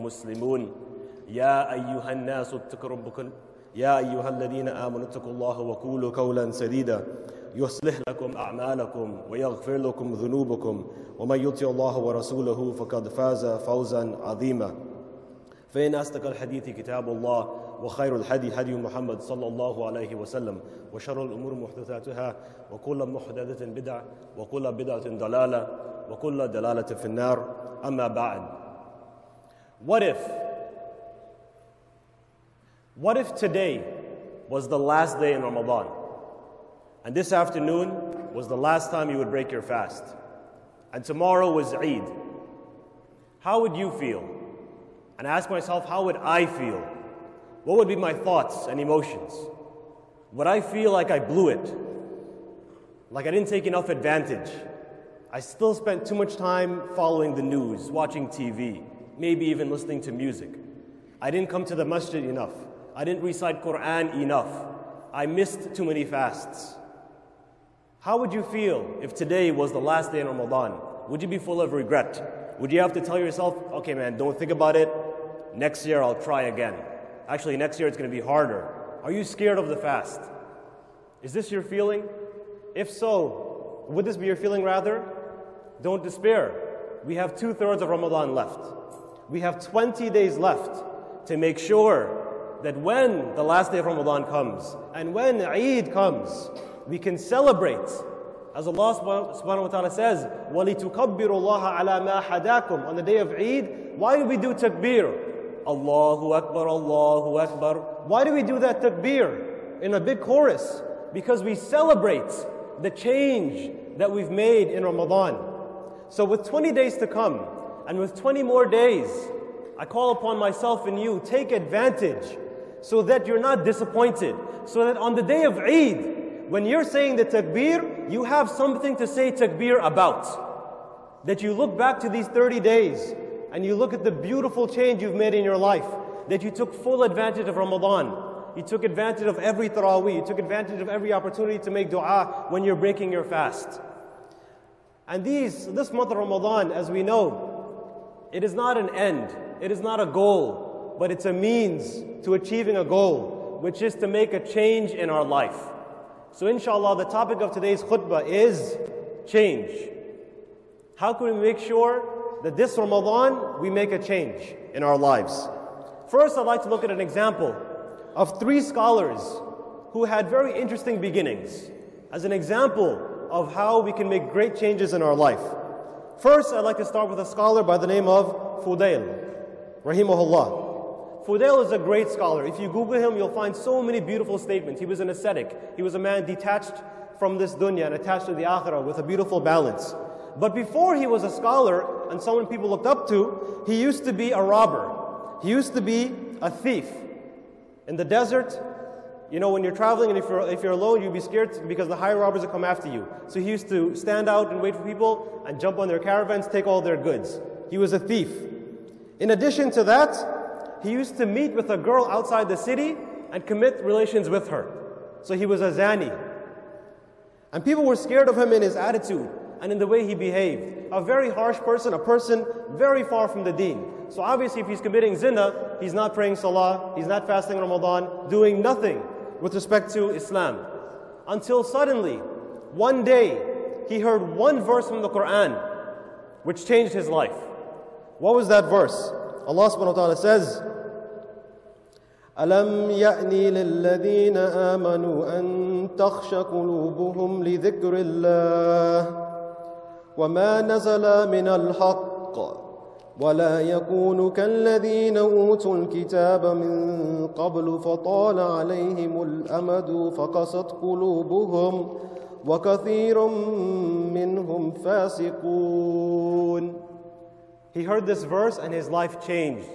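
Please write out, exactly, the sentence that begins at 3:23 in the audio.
So he used to stand out and wait for people and jump on their caravans, take all their goods.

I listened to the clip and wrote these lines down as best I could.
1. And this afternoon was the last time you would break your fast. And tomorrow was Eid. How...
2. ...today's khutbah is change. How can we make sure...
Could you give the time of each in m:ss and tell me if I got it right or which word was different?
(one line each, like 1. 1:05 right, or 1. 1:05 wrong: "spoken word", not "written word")
1. 0:37 right
2. 2:37 right.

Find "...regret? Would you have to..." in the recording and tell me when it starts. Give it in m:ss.
1:11.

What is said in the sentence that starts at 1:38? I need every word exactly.
As Allah subhanahu wa ta'ala says, وَلِتُكَبِّرُ اللَّهَ عَلَى مَا حَدَاكُمْ On the day of Eid, why do we do takbir?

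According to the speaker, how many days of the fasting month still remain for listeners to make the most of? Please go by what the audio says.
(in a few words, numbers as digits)
20.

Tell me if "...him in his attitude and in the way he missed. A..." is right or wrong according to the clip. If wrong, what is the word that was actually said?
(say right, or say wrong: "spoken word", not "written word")
wrong: "behaved", not "missed".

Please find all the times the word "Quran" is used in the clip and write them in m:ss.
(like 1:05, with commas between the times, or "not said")
1:03, 3:55.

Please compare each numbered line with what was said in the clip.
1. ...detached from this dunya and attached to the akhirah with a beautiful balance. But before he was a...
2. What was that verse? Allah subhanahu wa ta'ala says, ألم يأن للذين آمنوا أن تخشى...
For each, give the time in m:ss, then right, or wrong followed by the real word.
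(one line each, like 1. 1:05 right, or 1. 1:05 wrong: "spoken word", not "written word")
1. 3:06 right
2. 3:58 right.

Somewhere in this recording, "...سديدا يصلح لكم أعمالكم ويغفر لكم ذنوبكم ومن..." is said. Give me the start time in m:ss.
0:06.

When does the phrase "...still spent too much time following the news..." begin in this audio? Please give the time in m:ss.
0:55.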